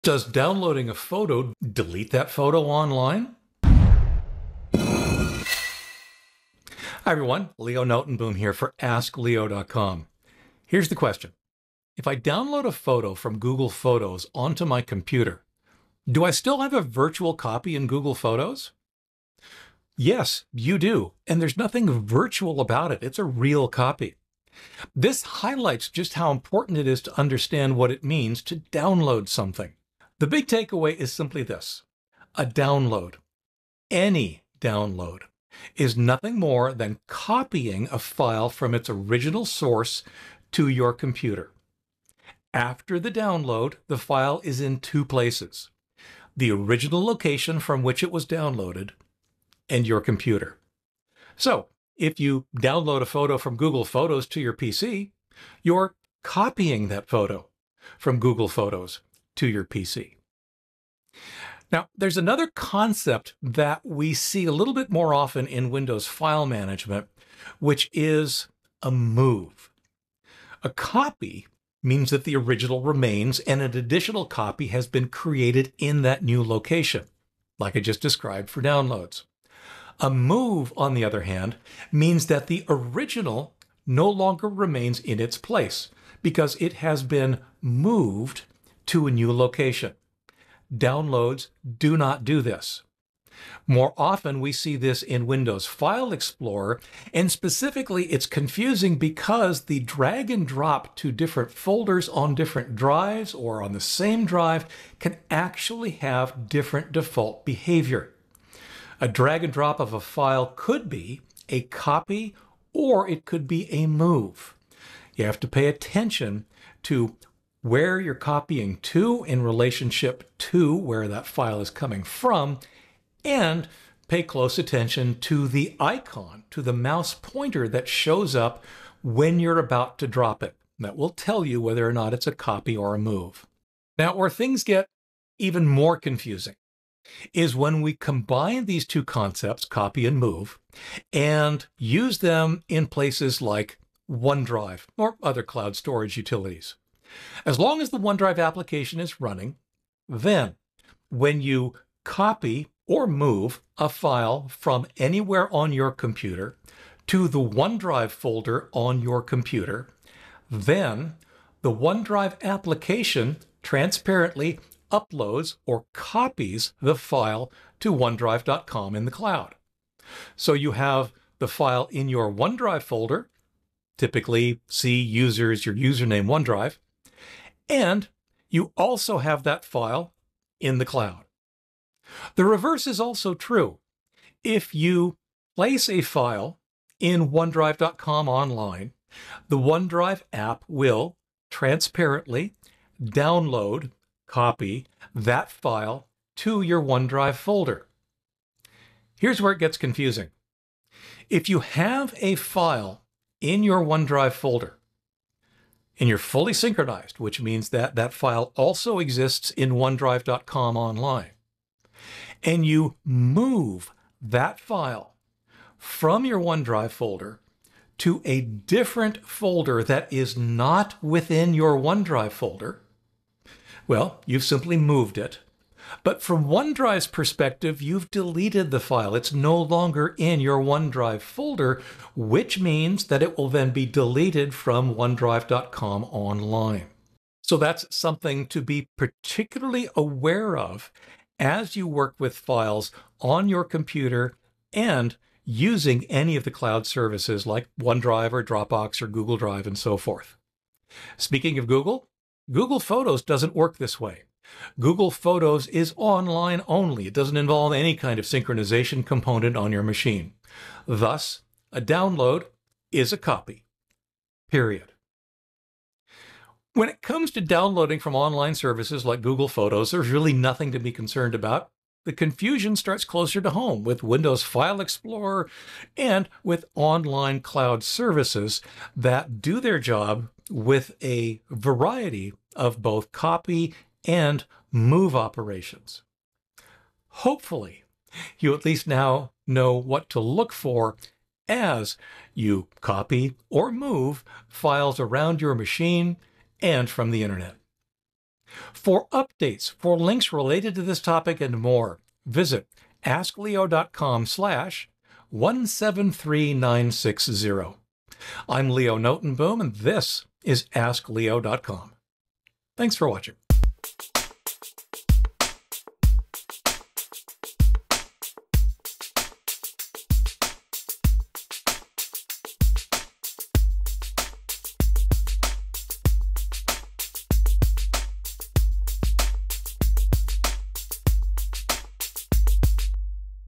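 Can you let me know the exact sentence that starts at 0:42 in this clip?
After the download, the file is in two places the original location from which it was downloaded and your computer.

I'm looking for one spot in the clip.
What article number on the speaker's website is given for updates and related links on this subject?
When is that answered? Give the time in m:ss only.
5:05.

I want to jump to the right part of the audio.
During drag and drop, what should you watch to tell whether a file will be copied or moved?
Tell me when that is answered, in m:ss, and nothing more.
2:06.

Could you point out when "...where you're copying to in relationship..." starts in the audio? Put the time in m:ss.
1:57.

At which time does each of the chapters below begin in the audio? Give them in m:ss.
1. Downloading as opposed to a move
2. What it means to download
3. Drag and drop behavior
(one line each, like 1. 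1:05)
1. 1:00
2. 0:30
3. 1:40.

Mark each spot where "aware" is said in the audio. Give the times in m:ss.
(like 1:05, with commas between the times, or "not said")
3:59.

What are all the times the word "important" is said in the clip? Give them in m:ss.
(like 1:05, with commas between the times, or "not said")
0:26.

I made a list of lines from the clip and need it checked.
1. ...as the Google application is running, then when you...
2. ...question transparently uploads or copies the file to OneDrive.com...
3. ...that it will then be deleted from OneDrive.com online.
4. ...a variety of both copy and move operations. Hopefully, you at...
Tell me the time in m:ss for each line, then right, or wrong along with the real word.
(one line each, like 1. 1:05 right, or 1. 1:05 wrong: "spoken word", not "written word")
1. 2:27 wrong: "OneDrive", not "Google"
2. 2:42 wrong: "application", not "question"
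3. 3:53 right
4. 4:41 right.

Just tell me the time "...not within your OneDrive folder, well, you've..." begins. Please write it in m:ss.
3:40.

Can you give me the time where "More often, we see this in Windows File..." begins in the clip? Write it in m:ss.
1:33.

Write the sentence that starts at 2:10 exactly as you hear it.
That will tell you whether or not it's a copy or a move.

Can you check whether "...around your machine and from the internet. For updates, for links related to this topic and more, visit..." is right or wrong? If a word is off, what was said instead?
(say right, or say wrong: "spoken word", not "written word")
right.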